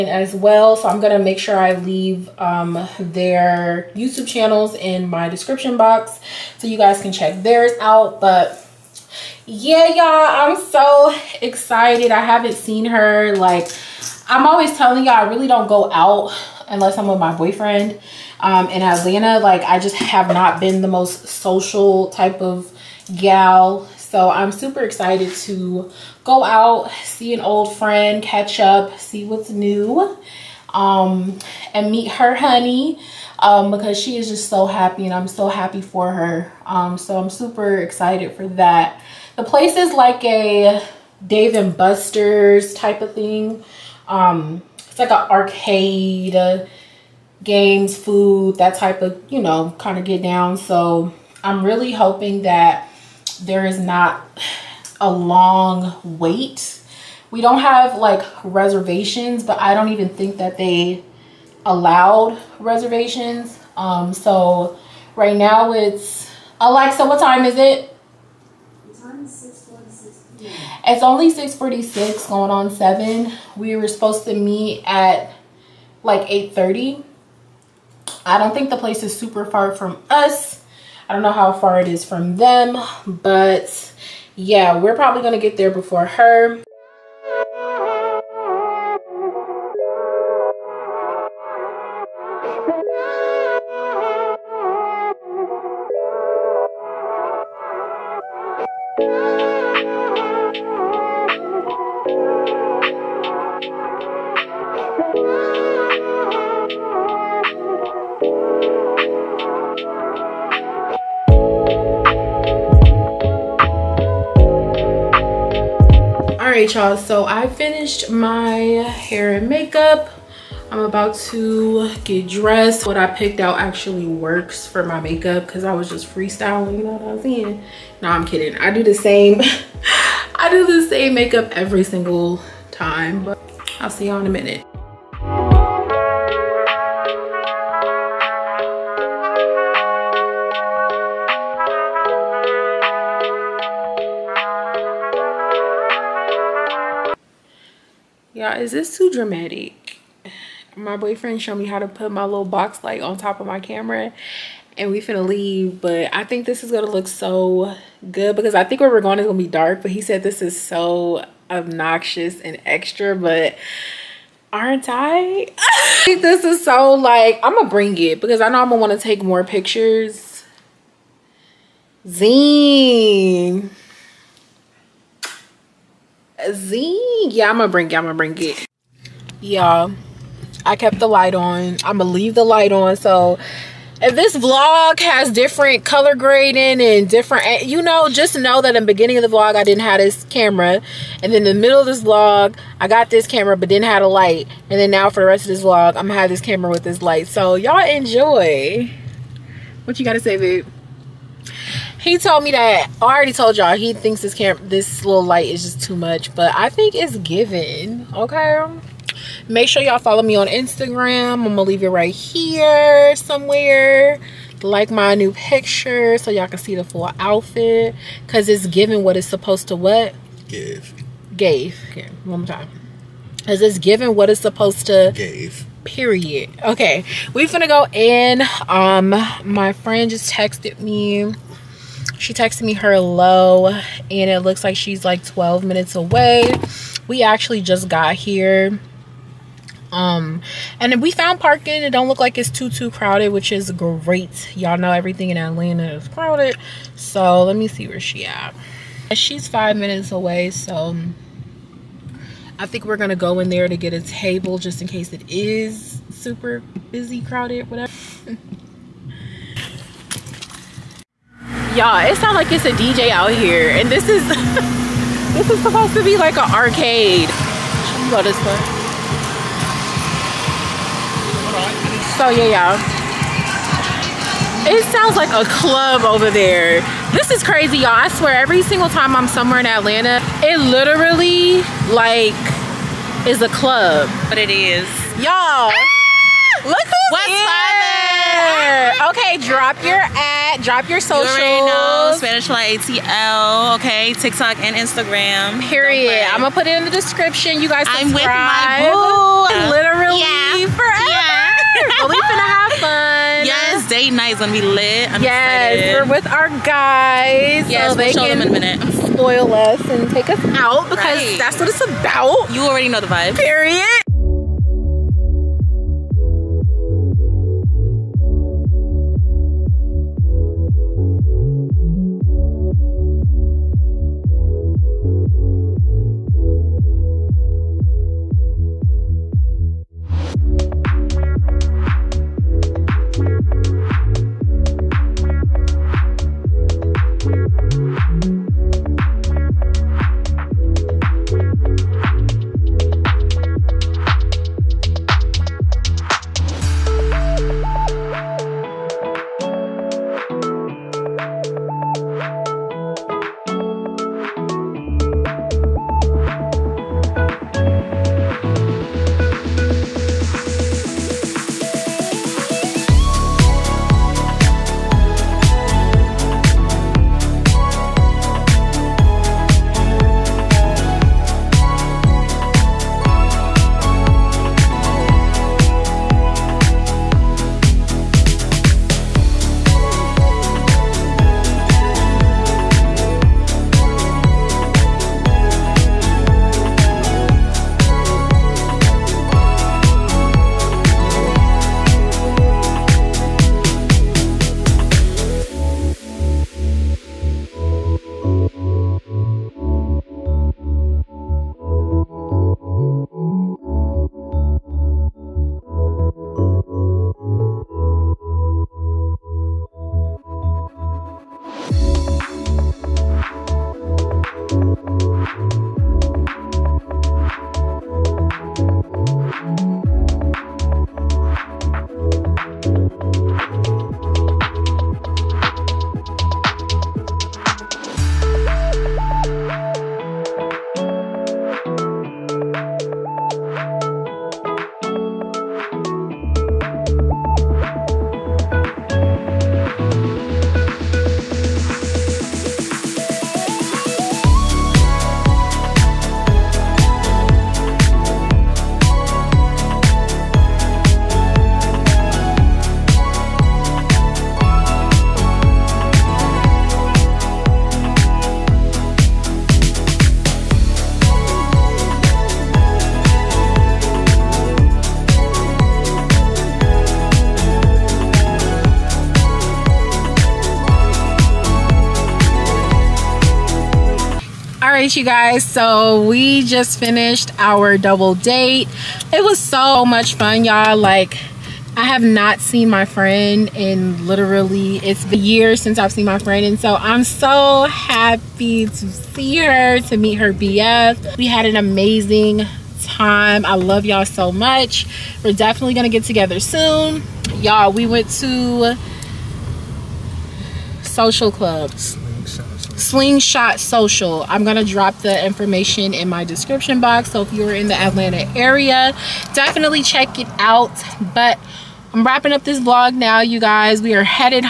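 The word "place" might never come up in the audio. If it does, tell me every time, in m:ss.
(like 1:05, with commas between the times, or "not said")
0:39, 1:18.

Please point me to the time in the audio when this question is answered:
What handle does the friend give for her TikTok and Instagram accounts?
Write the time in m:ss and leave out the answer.
4:52.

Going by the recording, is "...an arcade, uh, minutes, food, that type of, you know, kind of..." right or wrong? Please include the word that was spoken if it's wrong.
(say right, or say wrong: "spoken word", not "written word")
wrong: "games", not "minutes".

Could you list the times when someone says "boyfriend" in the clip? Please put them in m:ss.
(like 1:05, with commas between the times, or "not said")
0:17, 2:30.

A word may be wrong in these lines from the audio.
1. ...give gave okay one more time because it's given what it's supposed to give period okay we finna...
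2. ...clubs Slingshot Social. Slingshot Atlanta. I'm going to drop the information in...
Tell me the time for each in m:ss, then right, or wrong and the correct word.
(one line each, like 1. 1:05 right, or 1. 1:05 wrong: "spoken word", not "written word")
1. 3:40 right
2. 8:21 wrong: "Social", not "Atlanta".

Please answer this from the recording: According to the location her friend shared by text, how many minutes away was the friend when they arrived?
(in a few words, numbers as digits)
12 minutes.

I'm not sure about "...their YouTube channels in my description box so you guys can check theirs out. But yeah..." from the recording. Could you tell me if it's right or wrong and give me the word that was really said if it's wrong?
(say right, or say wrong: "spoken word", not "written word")
right.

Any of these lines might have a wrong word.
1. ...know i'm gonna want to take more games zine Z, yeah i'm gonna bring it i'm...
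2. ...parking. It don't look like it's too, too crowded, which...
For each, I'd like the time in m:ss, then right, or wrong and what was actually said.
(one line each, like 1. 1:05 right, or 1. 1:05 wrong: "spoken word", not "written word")
1. 2:48 wrong: "pictures", not "games"
2. 4:01 right.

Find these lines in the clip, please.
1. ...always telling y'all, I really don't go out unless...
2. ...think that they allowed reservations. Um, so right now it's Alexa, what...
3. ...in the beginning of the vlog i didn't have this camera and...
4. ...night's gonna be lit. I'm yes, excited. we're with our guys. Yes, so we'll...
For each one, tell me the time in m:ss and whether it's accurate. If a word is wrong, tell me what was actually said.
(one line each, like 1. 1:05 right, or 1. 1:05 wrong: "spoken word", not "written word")
1. 0:14 right
2. 1:00 right
3. 3:08 right
4. 5:04 right.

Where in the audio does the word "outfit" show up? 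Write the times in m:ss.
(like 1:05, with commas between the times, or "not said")
3:37.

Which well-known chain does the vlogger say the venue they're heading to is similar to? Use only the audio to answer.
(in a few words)
Dave and Buster's.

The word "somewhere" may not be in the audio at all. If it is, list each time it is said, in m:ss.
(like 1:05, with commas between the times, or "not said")
3:33, 4:39.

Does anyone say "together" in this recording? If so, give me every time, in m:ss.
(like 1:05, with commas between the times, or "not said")
8:16.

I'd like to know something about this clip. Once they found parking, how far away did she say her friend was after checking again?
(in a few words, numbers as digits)
Five minutes.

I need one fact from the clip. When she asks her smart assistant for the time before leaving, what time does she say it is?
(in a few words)
6:46.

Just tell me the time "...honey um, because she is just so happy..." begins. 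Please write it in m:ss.
0:32.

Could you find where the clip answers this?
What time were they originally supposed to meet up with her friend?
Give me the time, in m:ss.
1:16.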